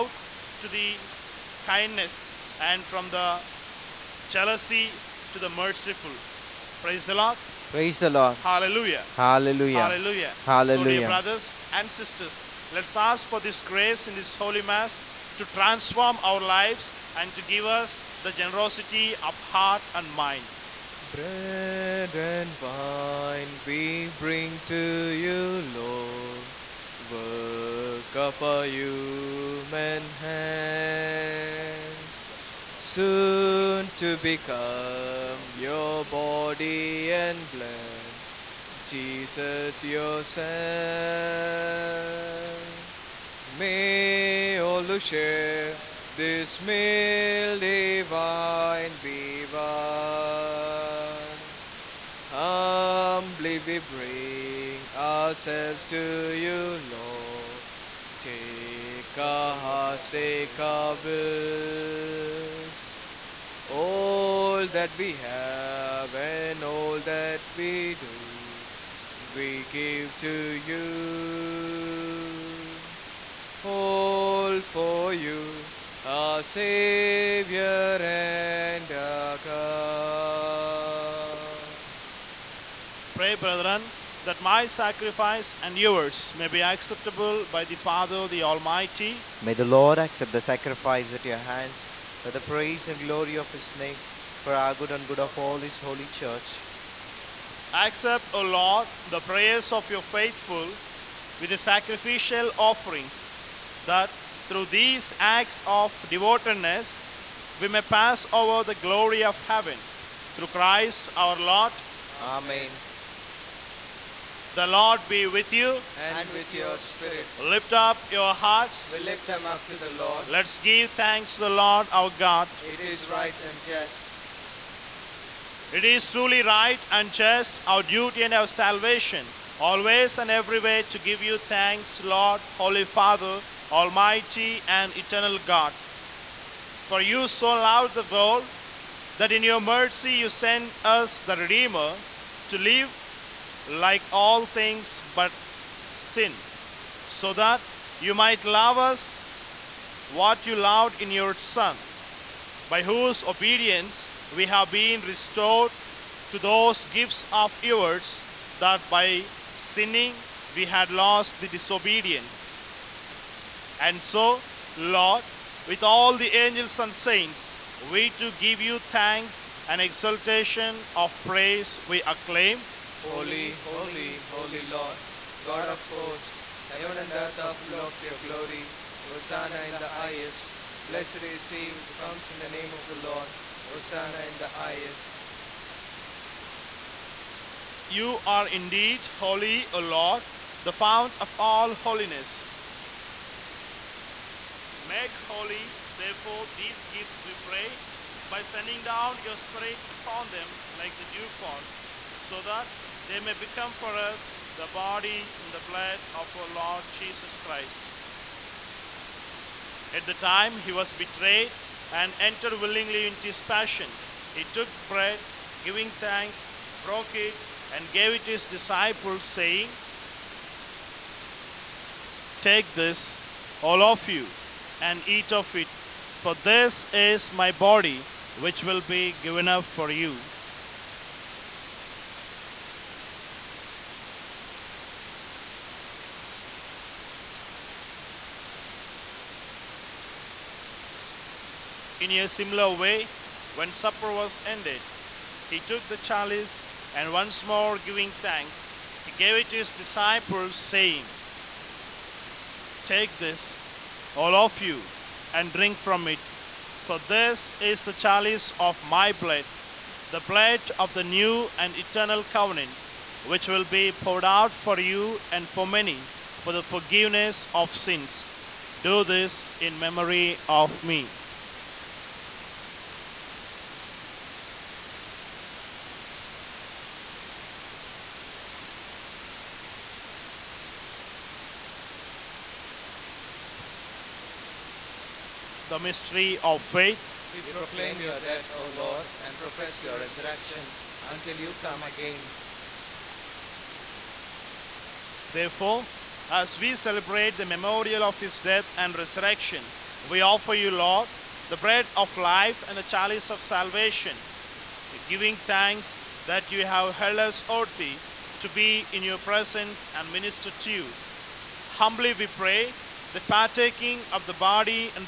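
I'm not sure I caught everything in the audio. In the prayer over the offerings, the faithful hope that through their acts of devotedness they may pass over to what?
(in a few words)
the glory of heaven.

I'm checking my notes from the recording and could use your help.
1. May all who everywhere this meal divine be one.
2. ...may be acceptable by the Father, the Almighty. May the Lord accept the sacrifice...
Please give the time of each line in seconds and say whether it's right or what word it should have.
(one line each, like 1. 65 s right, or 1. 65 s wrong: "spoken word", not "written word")
1. 43 s wrong: "share", not "everywhere"
2. 86 s right.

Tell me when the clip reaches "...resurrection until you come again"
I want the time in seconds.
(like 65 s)
289 s.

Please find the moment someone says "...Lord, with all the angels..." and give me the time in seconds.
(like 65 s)
164 s.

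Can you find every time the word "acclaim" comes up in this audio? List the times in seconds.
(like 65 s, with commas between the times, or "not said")
172 s.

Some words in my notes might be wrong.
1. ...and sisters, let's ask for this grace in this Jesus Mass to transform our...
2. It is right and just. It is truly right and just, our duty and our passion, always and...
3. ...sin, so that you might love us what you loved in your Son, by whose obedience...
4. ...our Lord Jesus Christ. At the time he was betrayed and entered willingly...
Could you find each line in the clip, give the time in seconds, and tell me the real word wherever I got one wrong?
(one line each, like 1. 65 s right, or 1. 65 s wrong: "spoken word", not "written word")
1. 11 s wrong: "Holy", not "Jesus"
2. 122 s wrong: "salvation", not "passion"
3. 145 s right
4. 206 s right.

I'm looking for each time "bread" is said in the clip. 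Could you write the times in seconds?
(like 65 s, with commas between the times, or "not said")
21 s, 214 s, 301 s.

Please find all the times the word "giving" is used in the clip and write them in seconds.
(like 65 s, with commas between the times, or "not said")
215 s, 247 s, 305 s.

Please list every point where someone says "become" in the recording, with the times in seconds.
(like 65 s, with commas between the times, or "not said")
34 s, 203 s.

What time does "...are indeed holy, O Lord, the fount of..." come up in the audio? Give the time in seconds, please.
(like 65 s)
188 s.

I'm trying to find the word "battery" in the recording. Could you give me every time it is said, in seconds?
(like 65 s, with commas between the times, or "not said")
not said.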